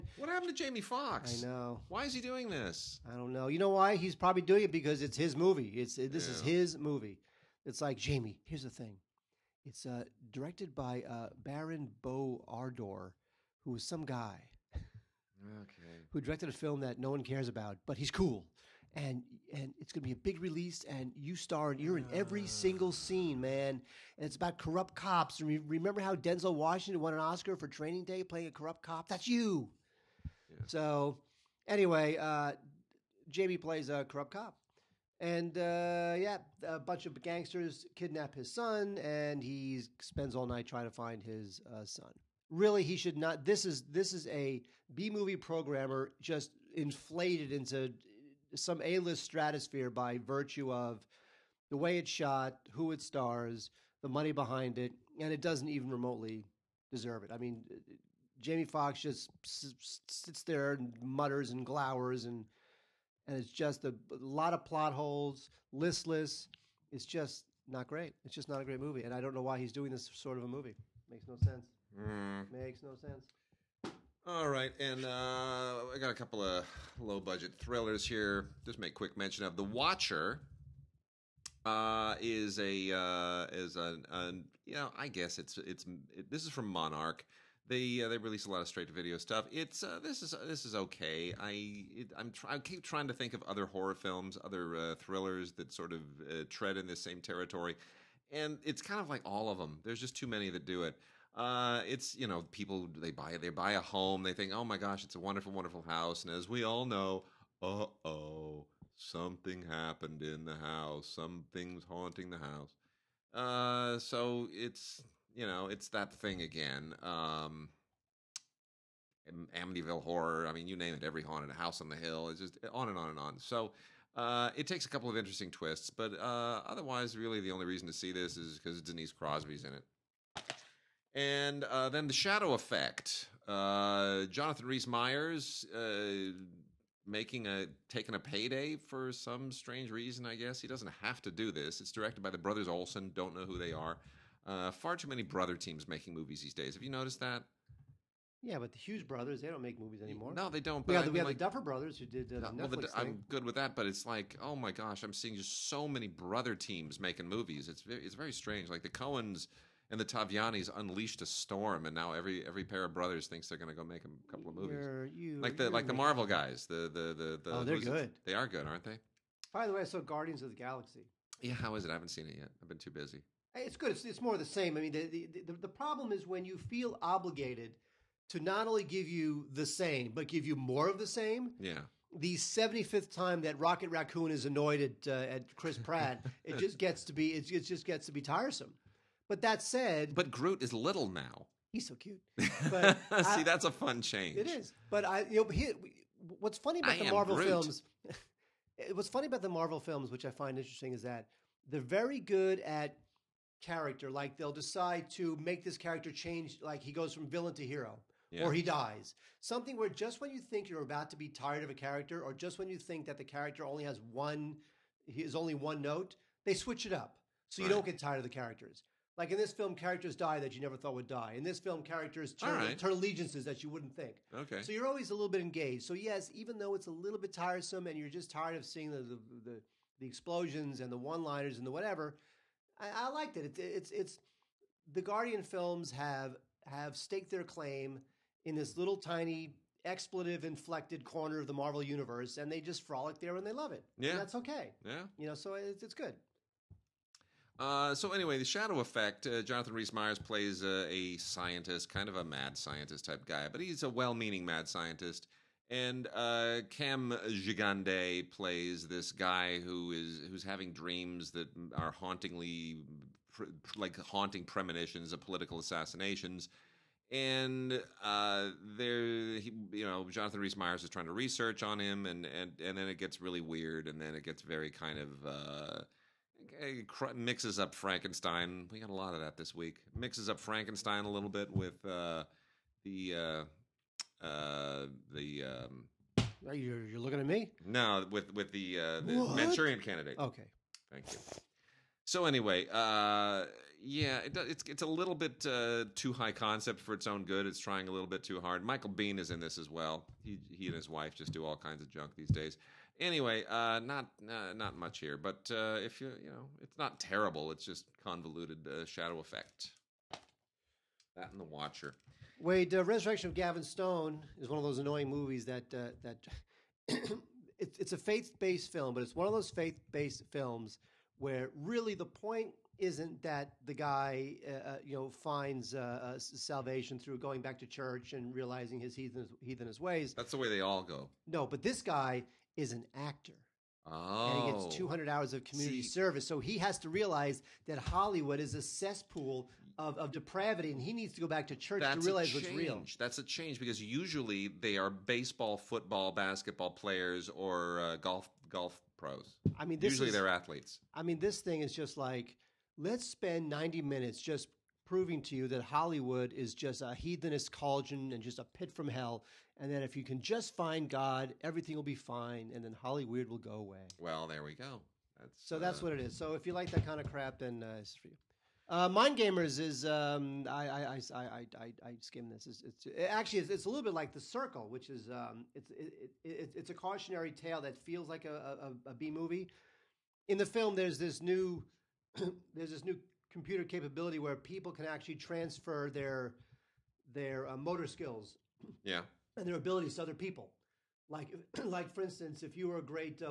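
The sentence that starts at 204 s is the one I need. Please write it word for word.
Like they'll decide to make this character change.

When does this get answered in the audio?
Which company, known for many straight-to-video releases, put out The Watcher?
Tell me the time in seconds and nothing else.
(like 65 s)
86 s.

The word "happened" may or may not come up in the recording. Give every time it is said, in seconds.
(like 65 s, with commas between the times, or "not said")
0 s, 109 s.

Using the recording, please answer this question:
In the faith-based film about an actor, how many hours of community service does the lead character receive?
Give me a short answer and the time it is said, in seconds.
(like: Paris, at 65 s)
200, at 334 s.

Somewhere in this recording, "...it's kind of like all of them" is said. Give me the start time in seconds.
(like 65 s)
98 s.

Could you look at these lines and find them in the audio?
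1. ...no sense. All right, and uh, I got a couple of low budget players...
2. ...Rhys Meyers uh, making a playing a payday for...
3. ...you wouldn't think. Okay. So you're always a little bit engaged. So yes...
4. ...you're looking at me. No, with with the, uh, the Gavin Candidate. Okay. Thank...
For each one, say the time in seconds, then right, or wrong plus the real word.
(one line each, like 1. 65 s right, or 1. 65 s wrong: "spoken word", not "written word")
1. 72 s wrong: "thrillers", not "players"
2. 134 s wrong: "taking", not "playing"
3. 223 s right
4. 286 s wrong: "Manchurian", not "Gavin".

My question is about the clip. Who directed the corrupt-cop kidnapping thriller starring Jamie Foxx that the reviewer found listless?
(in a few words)
Baran bo Odar.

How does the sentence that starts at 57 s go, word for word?
I mean, Jamie Foxx just sits there and mutters and glowers, and and it's just a, a lot of plot holes, listless.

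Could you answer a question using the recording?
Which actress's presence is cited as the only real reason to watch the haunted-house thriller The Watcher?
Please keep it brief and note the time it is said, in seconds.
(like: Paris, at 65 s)
Denise Crosby, at 128 s.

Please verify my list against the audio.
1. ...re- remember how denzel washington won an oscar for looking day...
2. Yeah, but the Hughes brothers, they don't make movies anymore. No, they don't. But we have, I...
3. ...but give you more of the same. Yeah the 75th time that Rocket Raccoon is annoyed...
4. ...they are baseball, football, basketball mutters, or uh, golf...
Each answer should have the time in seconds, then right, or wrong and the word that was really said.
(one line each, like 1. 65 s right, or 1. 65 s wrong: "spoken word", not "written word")
1. 25 s wrong: "training", not "looking"
2. 148 s right
3. 180 s right
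4. 344 s wrong: "players", not "mutters".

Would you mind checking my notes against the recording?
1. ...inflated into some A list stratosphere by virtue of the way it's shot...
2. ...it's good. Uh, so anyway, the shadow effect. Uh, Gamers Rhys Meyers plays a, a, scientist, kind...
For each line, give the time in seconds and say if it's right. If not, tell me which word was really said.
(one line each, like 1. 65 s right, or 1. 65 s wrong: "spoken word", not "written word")
1. 46 s right
2. 245 s wrong: "Jonathan", not "Gamers".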